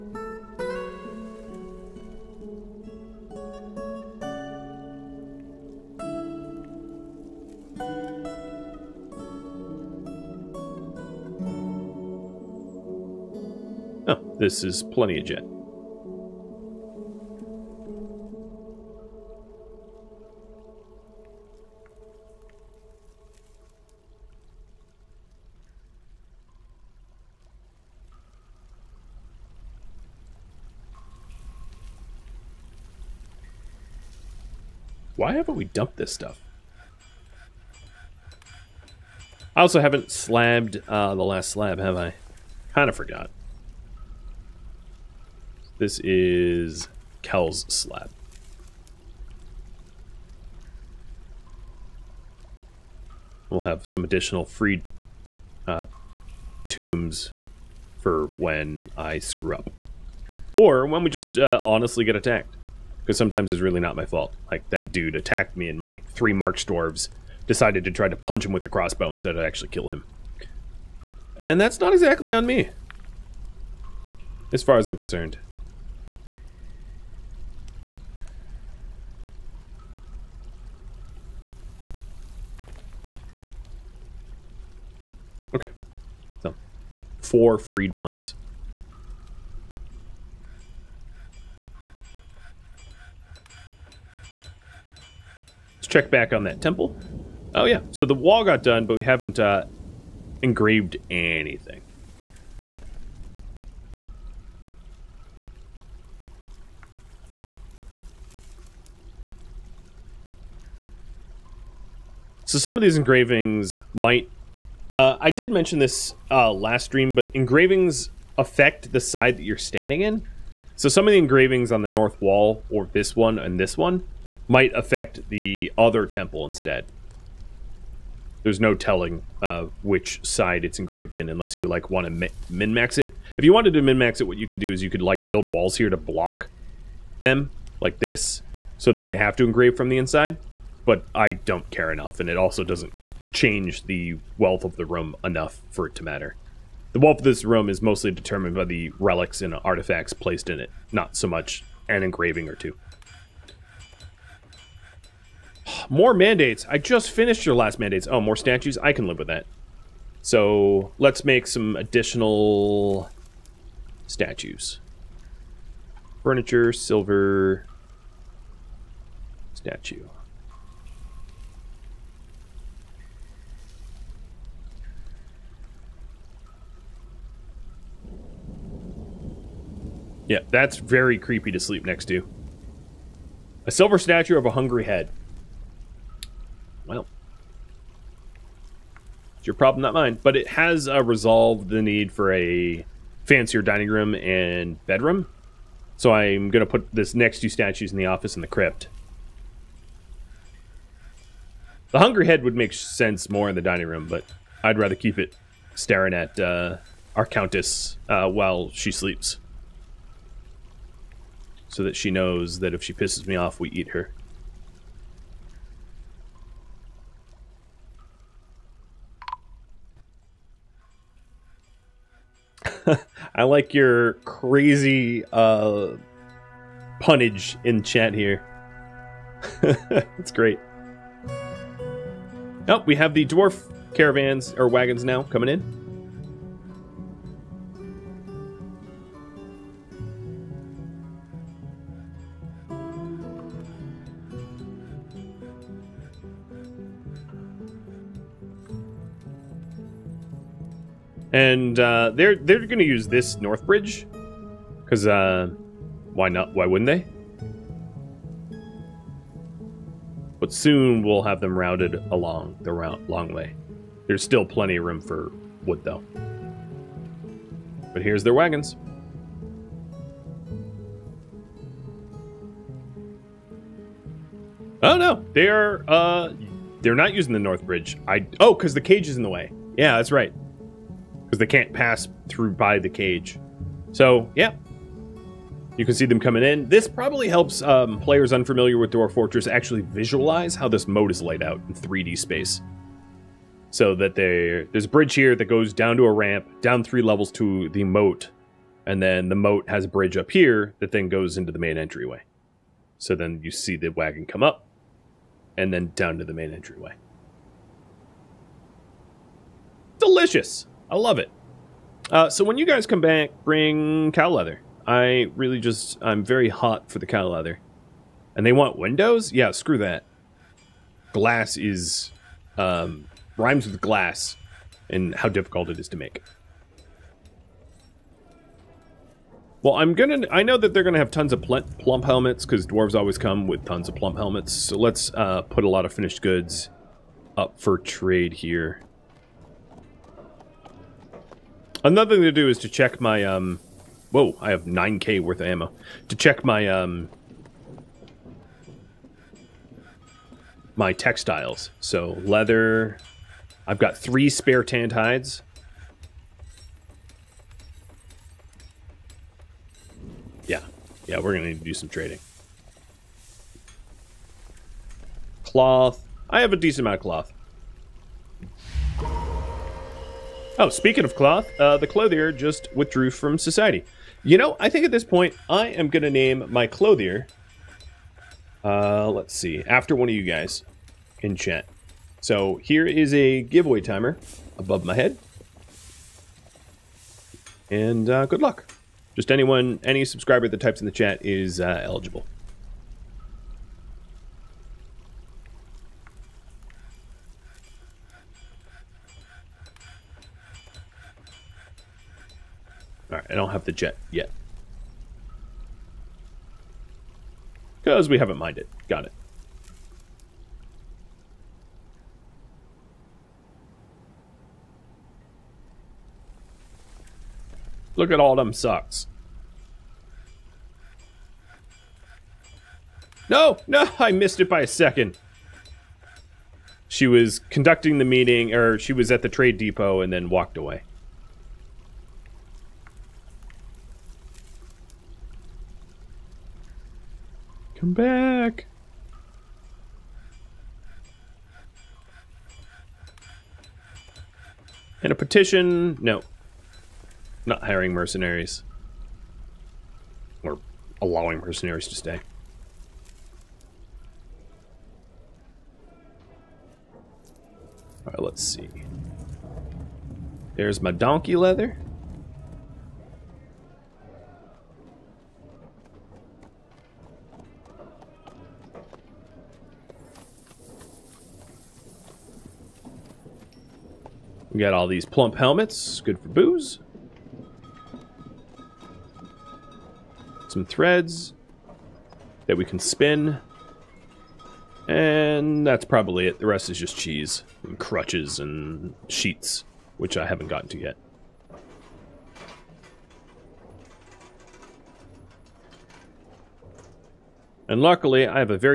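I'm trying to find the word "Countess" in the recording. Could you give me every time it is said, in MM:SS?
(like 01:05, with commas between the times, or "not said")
03:27.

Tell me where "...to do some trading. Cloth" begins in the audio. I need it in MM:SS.
06:01.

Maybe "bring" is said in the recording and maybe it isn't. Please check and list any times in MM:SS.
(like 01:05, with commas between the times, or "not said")
05:13.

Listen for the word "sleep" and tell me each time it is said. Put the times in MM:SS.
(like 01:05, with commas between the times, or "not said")
03:01, 03:28.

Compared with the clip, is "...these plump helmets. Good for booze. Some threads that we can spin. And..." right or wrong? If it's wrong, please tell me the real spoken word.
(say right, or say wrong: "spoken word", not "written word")
right.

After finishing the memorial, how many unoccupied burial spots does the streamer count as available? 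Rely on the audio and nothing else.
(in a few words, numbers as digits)
4.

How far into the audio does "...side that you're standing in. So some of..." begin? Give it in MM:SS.
01:59.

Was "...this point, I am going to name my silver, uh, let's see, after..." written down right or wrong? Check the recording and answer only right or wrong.
wrong.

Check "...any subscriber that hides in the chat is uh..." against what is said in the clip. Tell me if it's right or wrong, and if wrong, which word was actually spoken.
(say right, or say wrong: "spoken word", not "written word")
wrong: "types", not "hides".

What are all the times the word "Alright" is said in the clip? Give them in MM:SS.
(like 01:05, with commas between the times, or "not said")
06:43, 07:38.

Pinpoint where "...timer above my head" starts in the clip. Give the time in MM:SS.
06:23.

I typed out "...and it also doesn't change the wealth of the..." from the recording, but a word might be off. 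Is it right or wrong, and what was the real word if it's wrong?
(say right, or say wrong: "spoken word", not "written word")
right.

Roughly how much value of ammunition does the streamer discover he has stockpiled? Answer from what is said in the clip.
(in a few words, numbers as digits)
9k.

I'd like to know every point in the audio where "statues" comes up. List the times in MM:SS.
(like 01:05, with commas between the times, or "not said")
02:38, 02:44, 02:49, 03:03, 03:17.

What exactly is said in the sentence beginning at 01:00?
Or when we just uh, honestly get attacked because sometimes it's really not my fault.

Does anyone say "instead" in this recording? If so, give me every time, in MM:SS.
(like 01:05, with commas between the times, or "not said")
01:09, 02:06.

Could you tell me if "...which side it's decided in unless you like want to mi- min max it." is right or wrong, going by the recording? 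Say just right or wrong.
wrong.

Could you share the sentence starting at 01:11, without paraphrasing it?
And that's not exactly on me, as far as I'm concerned.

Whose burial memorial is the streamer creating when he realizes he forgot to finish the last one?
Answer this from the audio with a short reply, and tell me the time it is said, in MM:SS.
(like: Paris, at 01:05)
Kel, at 00:47.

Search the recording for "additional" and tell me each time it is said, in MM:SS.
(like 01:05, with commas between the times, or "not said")
00:54, 02:41.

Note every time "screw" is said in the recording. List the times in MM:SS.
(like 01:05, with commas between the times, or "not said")
00:59, 05:19.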